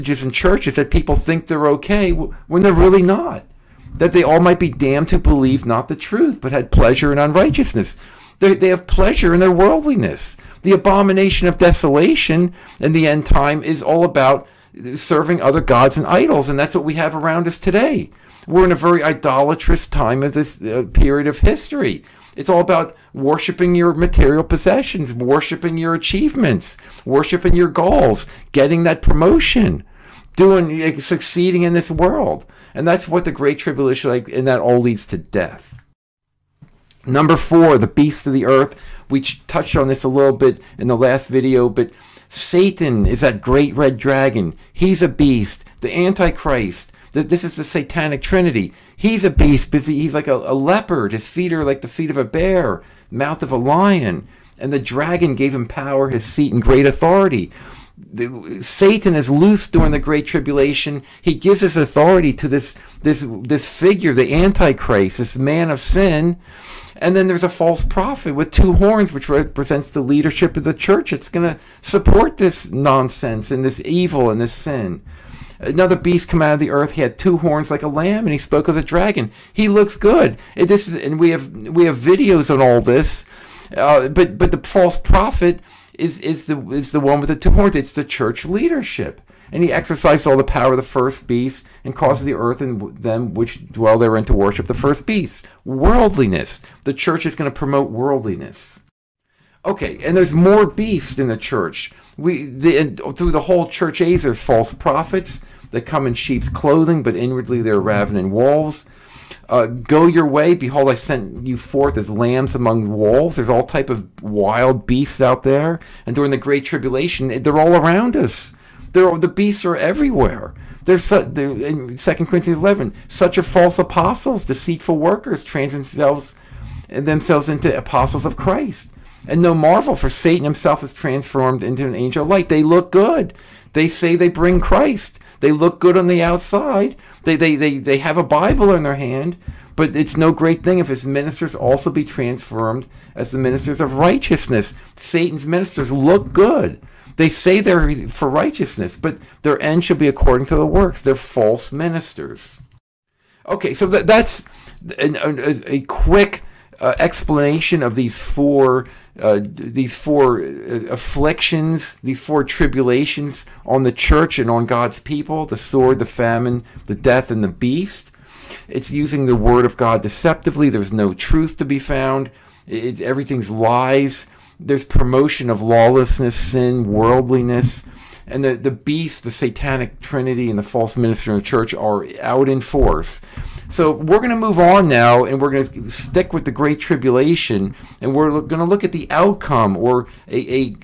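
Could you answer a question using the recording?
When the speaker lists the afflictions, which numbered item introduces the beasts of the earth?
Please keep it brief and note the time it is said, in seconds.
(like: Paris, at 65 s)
4, at 37 s.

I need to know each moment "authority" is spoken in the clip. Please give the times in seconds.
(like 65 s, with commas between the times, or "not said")
56 s, 61 s.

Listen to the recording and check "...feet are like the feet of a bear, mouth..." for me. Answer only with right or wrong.
right.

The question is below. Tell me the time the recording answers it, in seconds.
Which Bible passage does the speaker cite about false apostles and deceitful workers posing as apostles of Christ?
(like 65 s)
121 s.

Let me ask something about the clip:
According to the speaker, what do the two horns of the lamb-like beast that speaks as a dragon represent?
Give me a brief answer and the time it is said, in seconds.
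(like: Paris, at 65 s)
The leadership of the church, at 69 s.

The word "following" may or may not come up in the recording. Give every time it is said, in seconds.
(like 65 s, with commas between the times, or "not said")
not said.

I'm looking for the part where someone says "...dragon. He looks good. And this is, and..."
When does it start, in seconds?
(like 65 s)
78 s.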